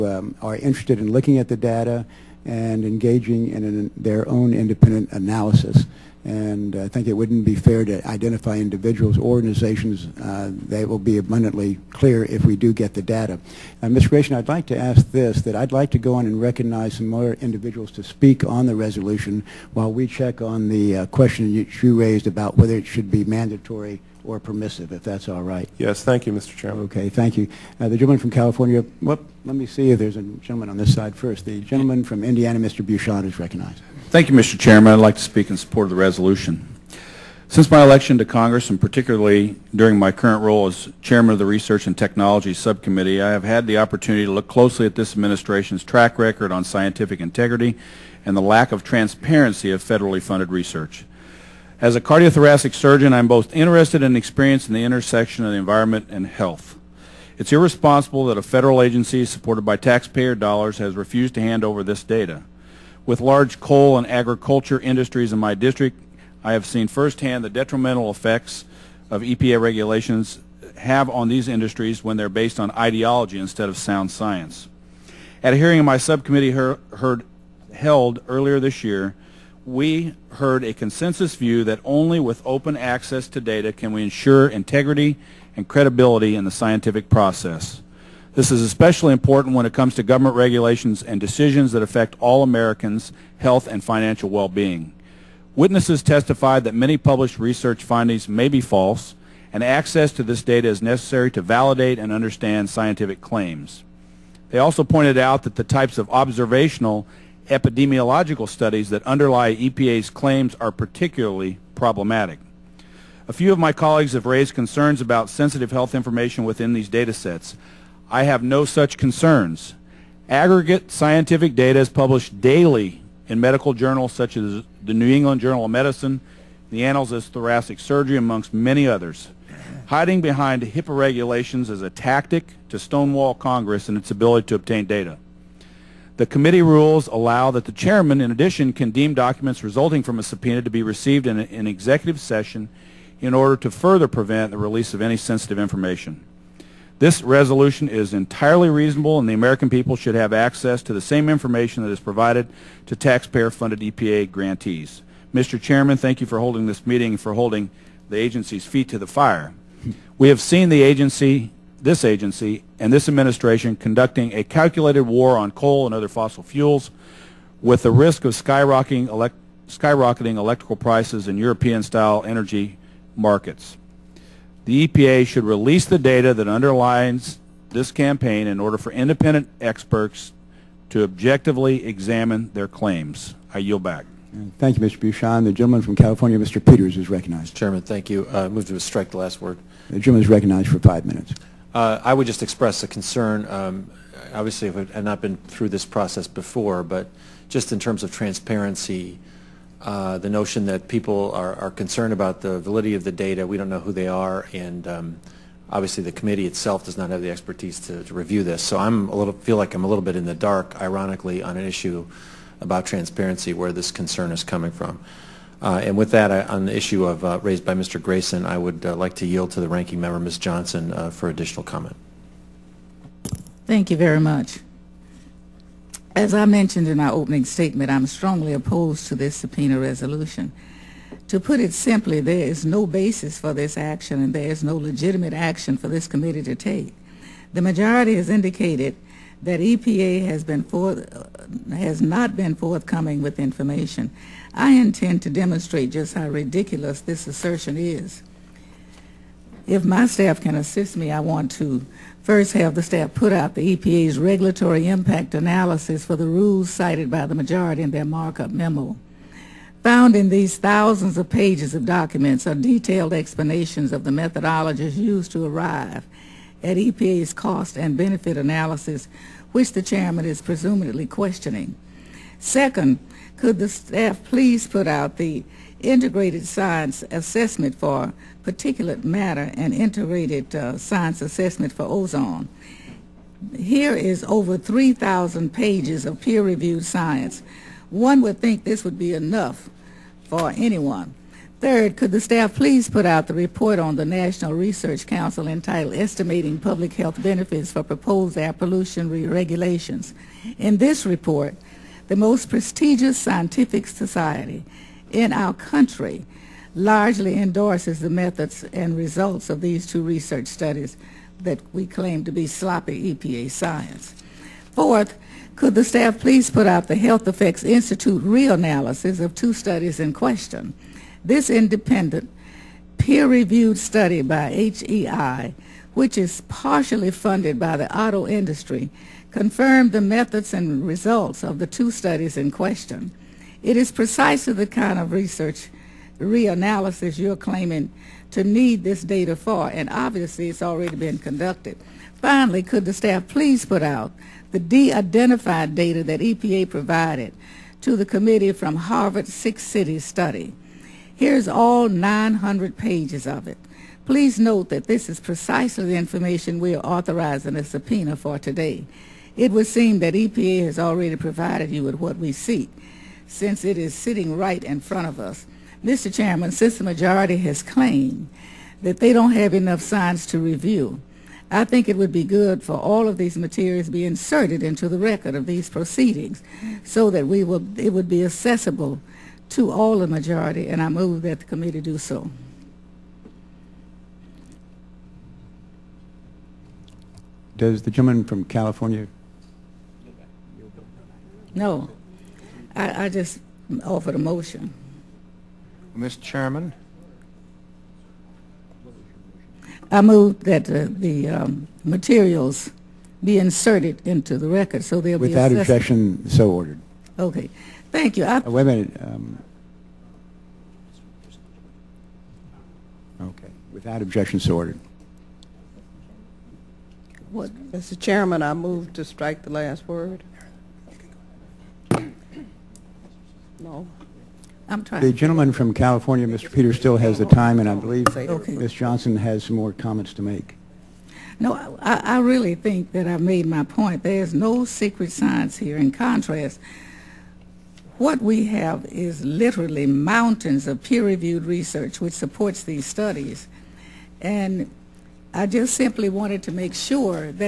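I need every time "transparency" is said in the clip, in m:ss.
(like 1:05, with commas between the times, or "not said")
0:48, 3:18, 3:32.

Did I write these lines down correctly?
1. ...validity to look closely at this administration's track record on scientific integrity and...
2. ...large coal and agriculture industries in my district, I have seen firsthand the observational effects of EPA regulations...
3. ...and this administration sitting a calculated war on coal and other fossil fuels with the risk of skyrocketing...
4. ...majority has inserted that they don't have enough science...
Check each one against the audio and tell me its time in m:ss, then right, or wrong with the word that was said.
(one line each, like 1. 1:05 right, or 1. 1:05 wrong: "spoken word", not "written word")
1. 0:43 wrong: "opportunity", not "validity"
2. 1:03 wrong: "detrimental", not "observational"
3. 2:42 wrong: "conducting", not "sitting"
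4. 6:06 wrong: "claimed", not "inserted".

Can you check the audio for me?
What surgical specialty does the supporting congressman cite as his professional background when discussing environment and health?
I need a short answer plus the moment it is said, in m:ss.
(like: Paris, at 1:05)
Cardiothoracic surgeon, at 0:52.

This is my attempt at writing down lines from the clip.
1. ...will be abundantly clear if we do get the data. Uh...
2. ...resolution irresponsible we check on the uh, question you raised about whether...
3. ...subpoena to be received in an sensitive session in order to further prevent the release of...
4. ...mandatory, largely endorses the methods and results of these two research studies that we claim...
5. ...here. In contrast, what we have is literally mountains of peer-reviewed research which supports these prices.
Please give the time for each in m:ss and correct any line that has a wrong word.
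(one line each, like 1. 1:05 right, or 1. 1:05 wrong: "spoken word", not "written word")
1. 0:10 right
2. 0:18 wrong: "while", not "irresponsible"
3. 2:20 wrong: "executive", not "sensitive"
4. 5:05 wrong: "country", not "mandatory"
5. 7:15 wrong: "studies", not "prices".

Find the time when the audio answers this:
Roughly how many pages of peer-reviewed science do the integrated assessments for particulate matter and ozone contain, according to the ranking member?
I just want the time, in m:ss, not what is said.
4:44.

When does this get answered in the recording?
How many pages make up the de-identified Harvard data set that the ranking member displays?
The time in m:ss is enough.
5:51.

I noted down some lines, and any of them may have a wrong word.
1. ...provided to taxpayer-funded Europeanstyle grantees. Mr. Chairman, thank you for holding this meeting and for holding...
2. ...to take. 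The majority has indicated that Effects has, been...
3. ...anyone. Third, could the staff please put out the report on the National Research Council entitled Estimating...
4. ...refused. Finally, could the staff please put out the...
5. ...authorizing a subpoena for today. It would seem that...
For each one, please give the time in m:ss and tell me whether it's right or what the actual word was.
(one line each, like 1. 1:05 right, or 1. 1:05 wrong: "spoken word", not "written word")
1. 2:32 wrong: "EPA", not "Europeanstyle"
2. 3:56 wrong: "EPA", not "Effects"
3. 4:50 right
4. 5:41 wrong: "conducted", not "refused"
5. 5:56 right.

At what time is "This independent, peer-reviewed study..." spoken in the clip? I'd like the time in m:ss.
5:21.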